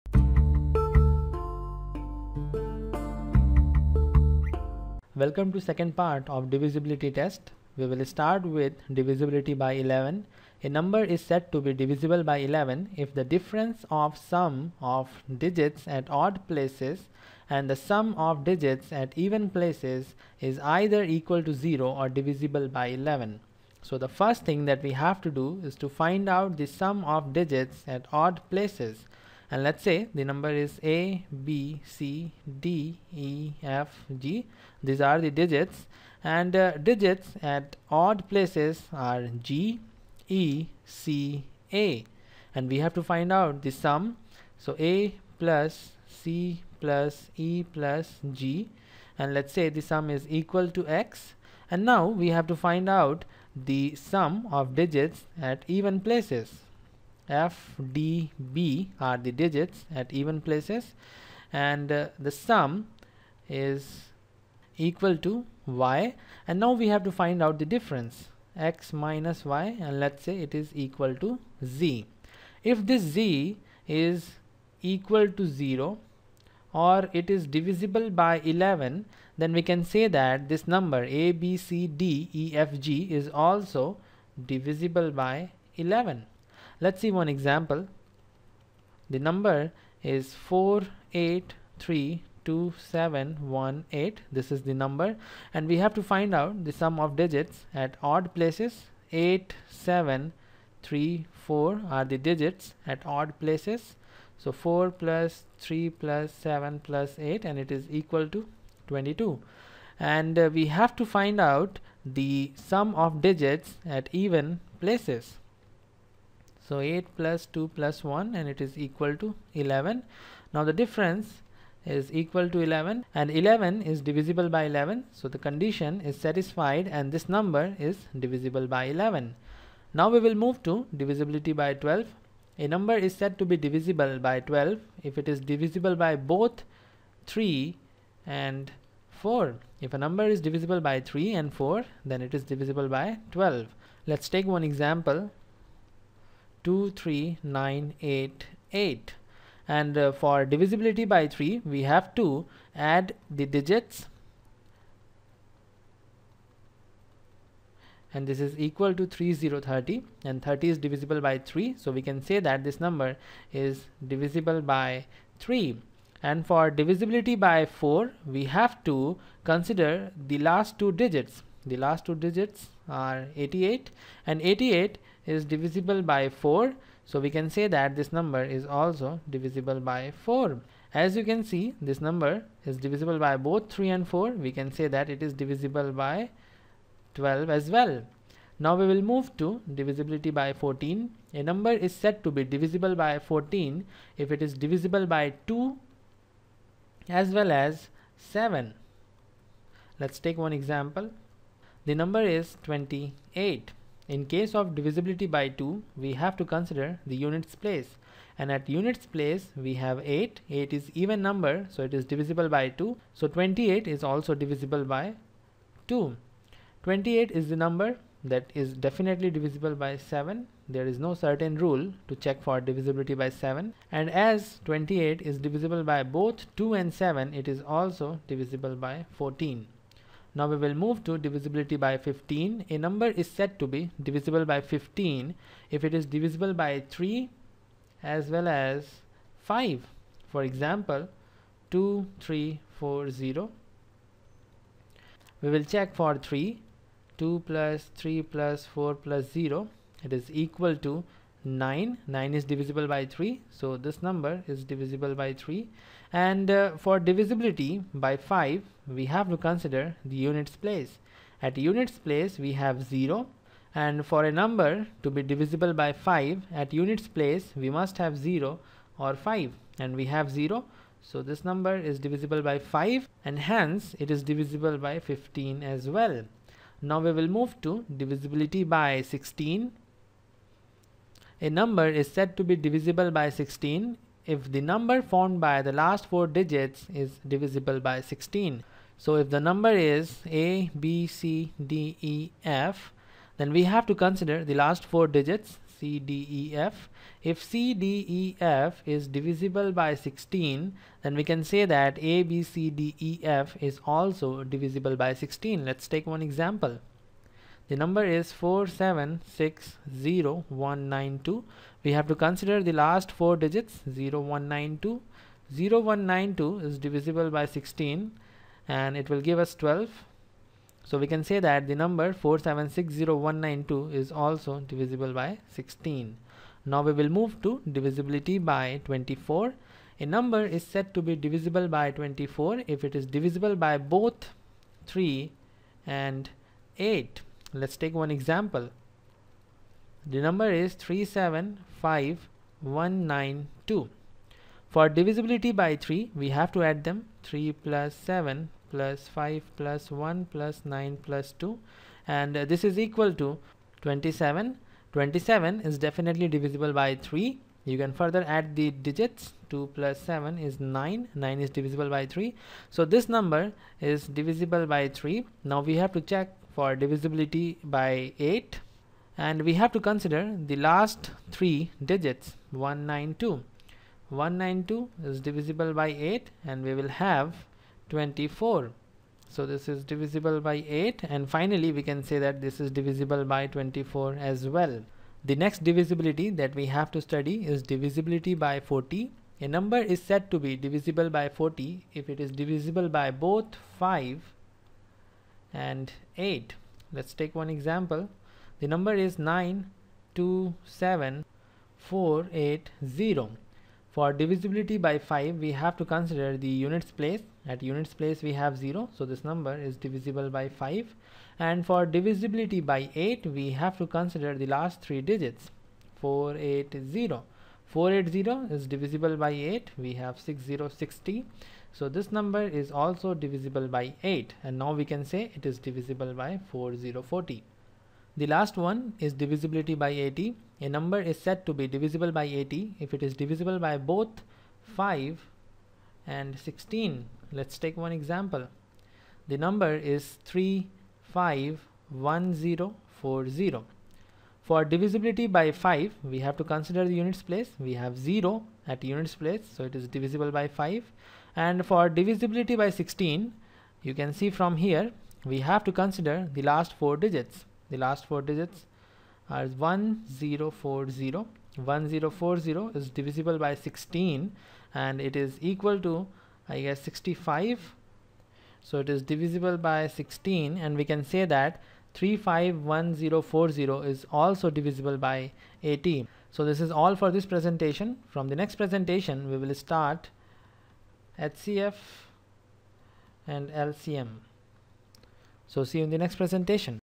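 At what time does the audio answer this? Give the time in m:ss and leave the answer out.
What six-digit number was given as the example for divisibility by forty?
6:39.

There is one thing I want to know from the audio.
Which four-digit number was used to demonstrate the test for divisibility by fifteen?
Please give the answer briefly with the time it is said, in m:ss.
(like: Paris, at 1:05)
2340, at 4:01.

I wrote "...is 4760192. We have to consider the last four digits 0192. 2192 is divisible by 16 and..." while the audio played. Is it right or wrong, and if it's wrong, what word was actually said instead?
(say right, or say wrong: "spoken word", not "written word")
wrong: "0192", not "2192".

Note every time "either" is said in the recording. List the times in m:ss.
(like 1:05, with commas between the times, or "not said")
0:20.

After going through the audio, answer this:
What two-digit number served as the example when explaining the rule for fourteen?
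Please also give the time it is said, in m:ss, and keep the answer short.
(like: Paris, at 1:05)
28, at 3:21.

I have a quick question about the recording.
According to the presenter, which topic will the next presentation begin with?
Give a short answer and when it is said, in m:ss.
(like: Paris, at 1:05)
HCF and LCM, at 8:01.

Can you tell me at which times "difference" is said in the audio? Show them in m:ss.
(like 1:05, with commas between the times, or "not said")
0:13, 1:07, 2:00.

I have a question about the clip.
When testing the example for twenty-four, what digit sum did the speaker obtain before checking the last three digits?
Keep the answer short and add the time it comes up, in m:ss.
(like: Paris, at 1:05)
27, at 5:52.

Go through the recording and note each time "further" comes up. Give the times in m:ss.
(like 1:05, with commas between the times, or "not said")
5:57.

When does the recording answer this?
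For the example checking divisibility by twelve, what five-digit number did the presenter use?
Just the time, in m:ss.
2:26.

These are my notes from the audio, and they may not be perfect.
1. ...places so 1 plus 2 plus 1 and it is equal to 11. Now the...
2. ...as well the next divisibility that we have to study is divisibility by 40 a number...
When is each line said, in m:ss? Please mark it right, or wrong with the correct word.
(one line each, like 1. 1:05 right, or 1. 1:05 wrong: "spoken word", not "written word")
1. 1:54 wrong: "8", not "1"
2. 6:24 right.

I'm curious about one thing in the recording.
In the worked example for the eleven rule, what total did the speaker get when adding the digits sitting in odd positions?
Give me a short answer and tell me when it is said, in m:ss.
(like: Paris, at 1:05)
22, at 1:47.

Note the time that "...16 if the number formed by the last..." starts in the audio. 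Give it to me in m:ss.
4:43.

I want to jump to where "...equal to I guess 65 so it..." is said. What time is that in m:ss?
7:45.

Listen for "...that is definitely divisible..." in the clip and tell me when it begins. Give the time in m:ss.
3:38.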